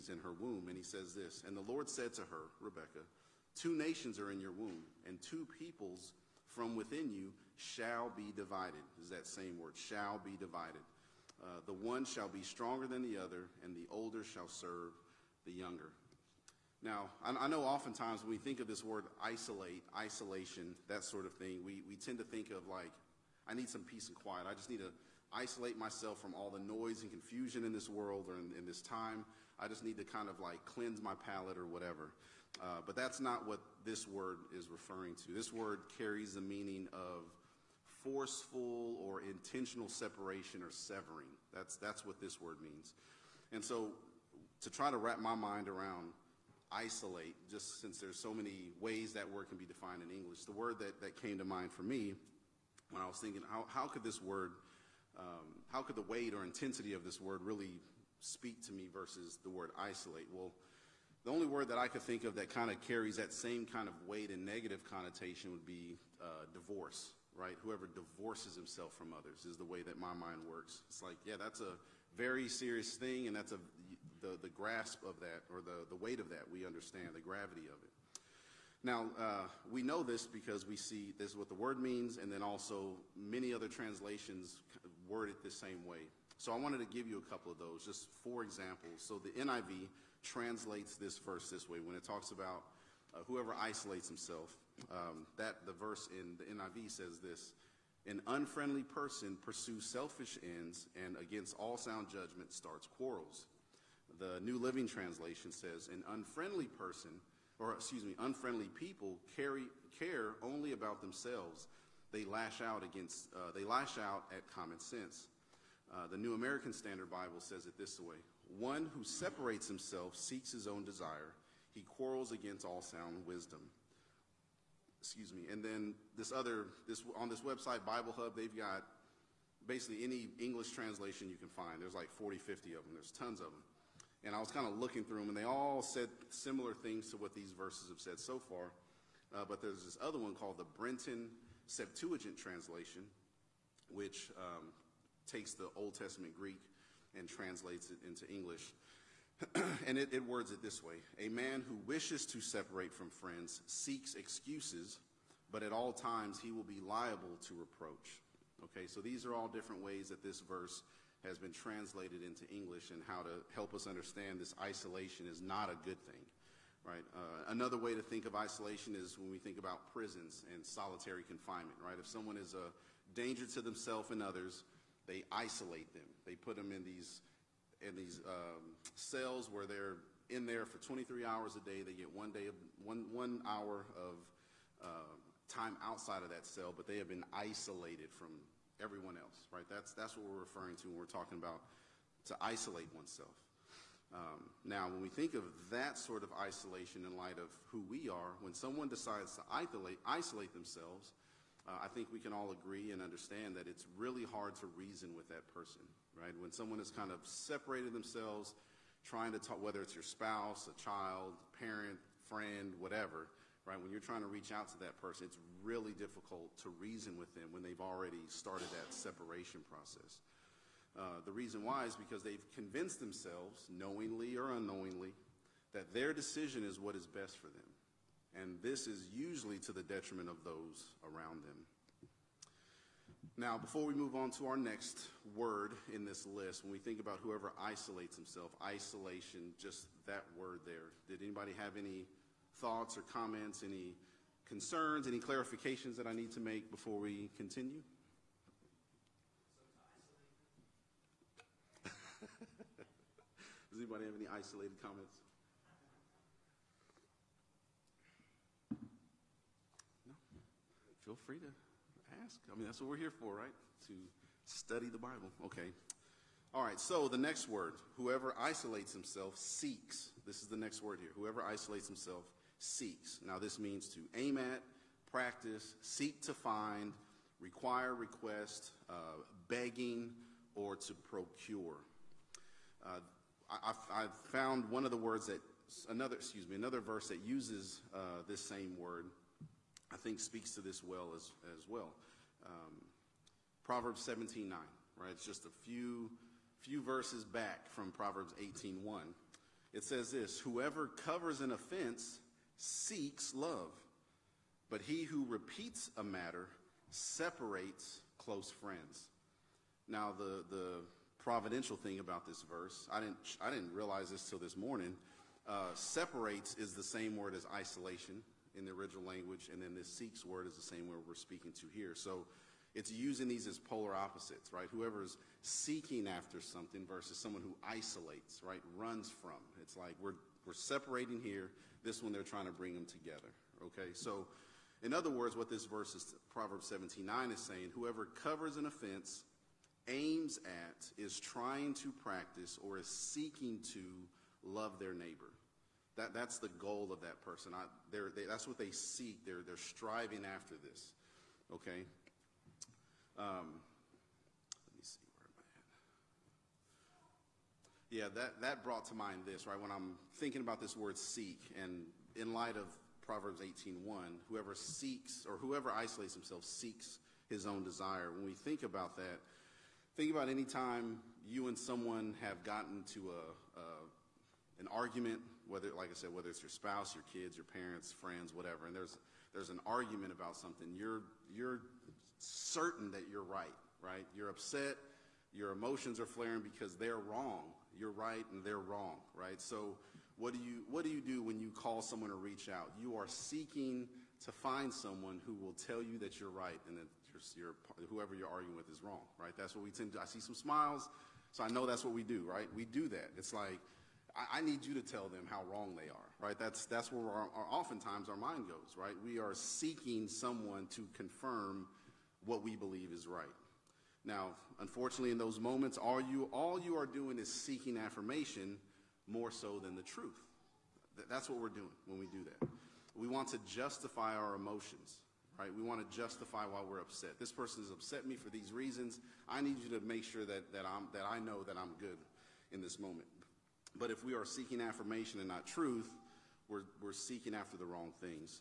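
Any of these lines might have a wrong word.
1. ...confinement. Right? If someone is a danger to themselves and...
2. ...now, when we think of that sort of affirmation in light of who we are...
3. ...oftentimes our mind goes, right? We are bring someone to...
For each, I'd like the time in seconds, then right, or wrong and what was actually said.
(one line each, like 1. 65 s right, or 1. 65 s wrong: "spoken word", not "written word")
1. 171 s right
2. 194 s wrong: "isolation", not "affirmation"
3. 407 s wrong: "seeking", not "bring".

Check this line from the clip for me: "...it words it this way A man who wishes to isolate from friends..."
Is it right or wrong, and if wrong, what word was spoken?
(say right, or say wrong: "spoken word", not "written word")
wrong: "separate", not "isolate".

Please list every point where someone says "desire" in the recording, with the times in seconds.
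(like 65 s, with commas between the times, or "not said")
120 s, 367 s.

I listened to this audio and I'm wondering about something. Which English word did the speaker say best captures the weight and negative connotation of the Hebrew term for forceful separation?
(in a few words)
Divorce.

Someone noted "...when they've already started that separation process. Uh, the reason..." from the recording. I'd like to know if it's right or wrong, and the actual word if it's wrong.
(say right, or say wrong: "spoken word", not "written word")
right.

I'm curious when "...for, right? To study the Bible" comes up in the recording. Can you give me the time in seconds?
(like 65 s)
263 s.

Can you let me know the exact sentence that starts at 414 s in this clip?
Now, unfortunately, in those moments, all you, all you are doing is seeking affirmation more so than the truth.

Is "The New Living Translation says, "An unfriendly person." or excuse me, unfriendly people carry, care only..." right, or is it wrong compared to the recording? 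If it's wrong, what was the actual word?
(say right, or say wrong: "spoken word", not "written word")
right.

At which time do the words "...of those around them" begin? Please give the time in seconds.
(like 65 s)
230 s.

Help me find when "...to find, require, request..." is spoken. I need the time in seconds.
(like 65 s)
276 s.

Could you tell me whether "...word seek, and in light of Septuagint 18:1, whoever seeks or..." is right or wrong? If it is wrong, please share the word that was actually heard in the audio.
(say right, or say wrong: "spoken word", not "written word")
wrong: "Proverbs", not "Septuagint".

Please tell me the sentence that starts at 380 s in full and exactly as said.
You're you're certain that you're right, right?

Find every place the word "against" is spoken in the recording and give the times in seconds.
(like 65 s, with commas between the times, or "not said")
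101 s, 112 s, 122 s.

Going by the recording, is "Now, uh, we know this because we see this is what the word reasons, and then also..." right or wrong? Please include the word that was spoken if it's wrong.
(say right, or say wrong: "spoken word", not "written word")
wrong: "means", not "reasons".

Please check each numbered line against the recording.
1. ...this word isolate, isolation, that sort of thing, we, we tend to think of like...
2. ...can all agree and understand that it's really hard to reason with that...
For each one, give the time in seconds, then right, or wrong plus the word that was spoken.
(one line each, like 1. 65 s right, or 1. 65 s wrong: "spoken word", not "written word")
1. 18 s right
2. 202 s right.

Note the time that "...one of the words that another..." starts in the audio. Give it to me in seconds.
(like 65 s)
284 s.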